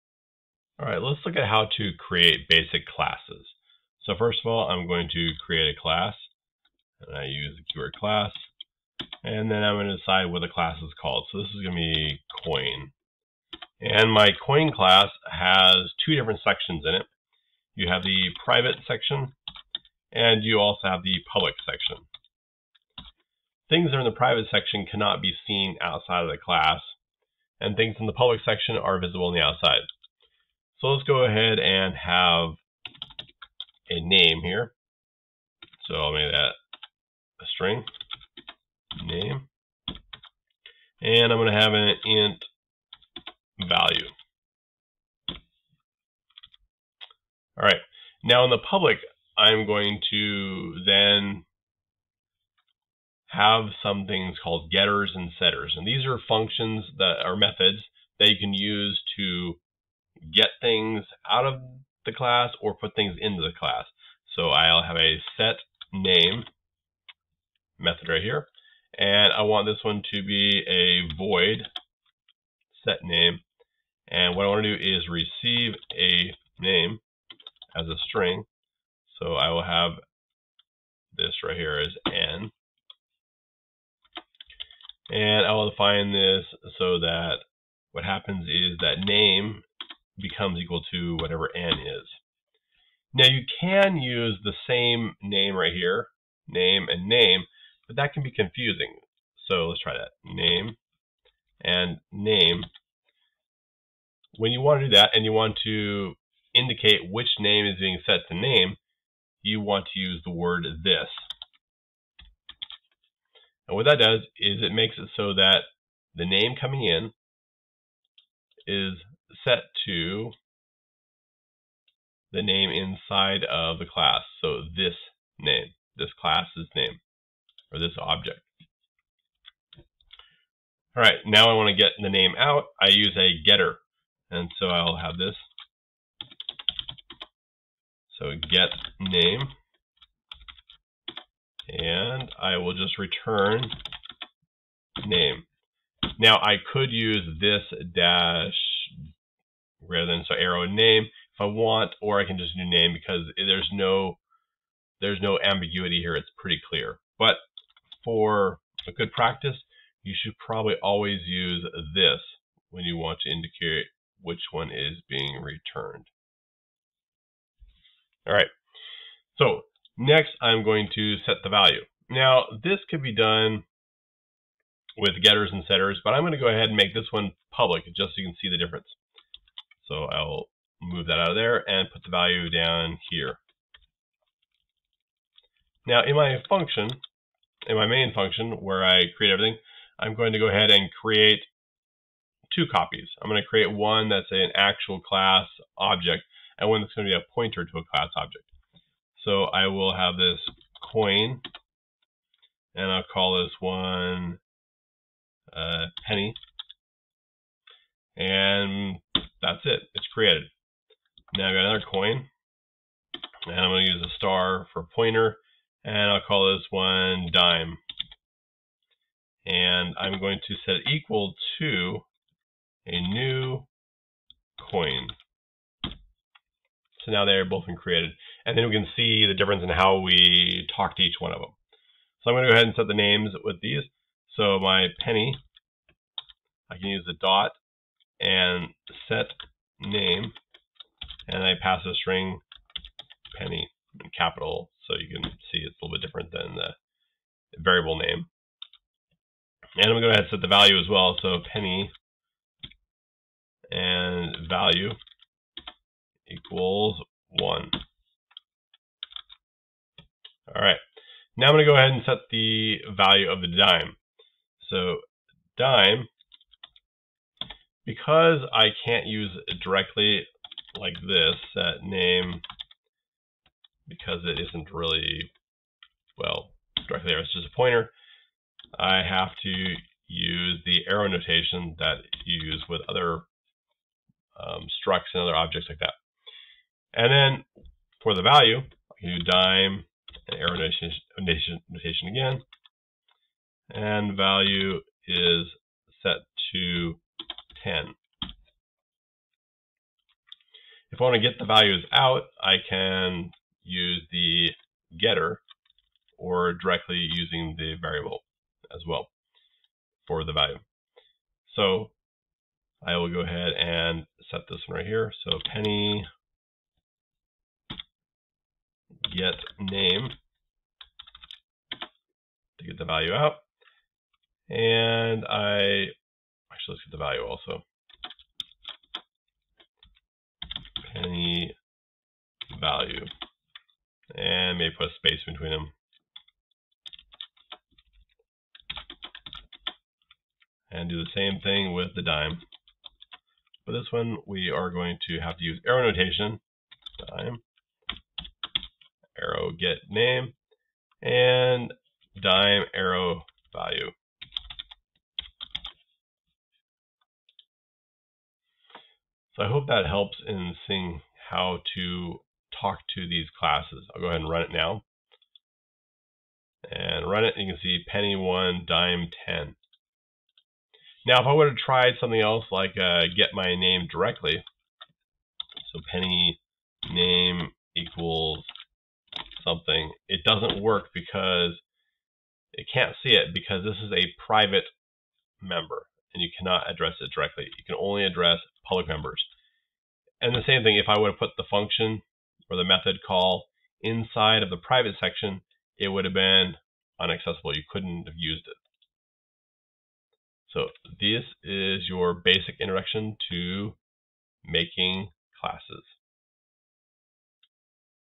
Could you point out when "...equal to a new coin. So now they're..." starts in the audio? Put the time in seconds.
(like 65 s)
220 s.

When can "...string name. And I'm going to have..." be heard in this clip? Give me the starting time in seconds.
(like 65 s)
37 s.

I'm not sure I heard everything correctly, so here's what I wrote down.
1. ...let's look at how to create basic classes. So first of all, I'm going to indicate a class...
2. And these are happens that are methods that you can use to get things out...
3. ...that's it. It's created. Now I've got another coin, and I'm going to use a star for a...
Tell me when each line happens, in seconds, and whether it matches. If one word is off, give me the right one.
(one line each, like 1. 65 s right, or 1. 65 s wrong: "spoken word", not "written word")
1. 1 s wrong: "create", not "indicate"
2. 55 s wrong: "functions", not "happens"
3. 209 s right.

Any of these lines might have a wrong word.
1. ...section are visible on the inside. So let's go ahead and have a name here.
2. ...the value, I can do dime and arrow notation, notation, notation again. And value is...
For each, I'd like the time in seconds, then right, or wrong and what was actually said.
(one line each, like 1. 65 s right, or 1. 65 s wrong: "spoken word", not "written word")
1. 28 s wrong: "outside", not "inside"
2. 288 s right.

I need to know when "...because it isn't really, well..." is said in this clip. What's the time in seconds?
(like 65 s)
273 s.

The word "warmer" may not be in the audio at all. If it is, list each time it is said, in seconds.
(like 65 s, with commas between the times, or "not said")
not said.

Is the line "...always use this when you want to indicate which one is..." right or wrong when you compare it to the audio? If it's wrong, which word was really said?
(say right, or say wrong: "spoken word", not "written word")
right.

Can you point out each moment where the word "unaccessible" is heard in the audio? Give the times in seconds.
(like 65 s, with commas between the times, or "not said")
396 s.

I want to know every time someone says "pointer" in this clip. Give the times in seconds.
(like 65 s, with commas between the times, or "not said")
197 s, 214 s, 277 s.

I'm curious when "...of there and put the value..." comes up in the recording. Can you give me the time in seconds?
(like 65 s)
181 s.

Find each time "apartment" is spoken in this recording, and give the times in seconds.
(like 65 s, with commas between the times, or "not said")
not said.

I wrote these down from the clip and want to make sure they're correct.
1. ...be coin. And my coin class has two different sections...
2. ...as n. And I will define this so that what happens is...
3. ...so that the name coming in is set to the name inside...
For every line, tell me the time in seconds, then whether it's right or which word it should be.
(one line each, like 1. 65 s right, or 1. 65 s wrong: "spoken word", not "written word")
1. 11 s right
2. 81 s right
3. 115 s right.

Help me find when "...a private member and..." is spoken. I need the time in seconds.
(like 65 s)
383 s.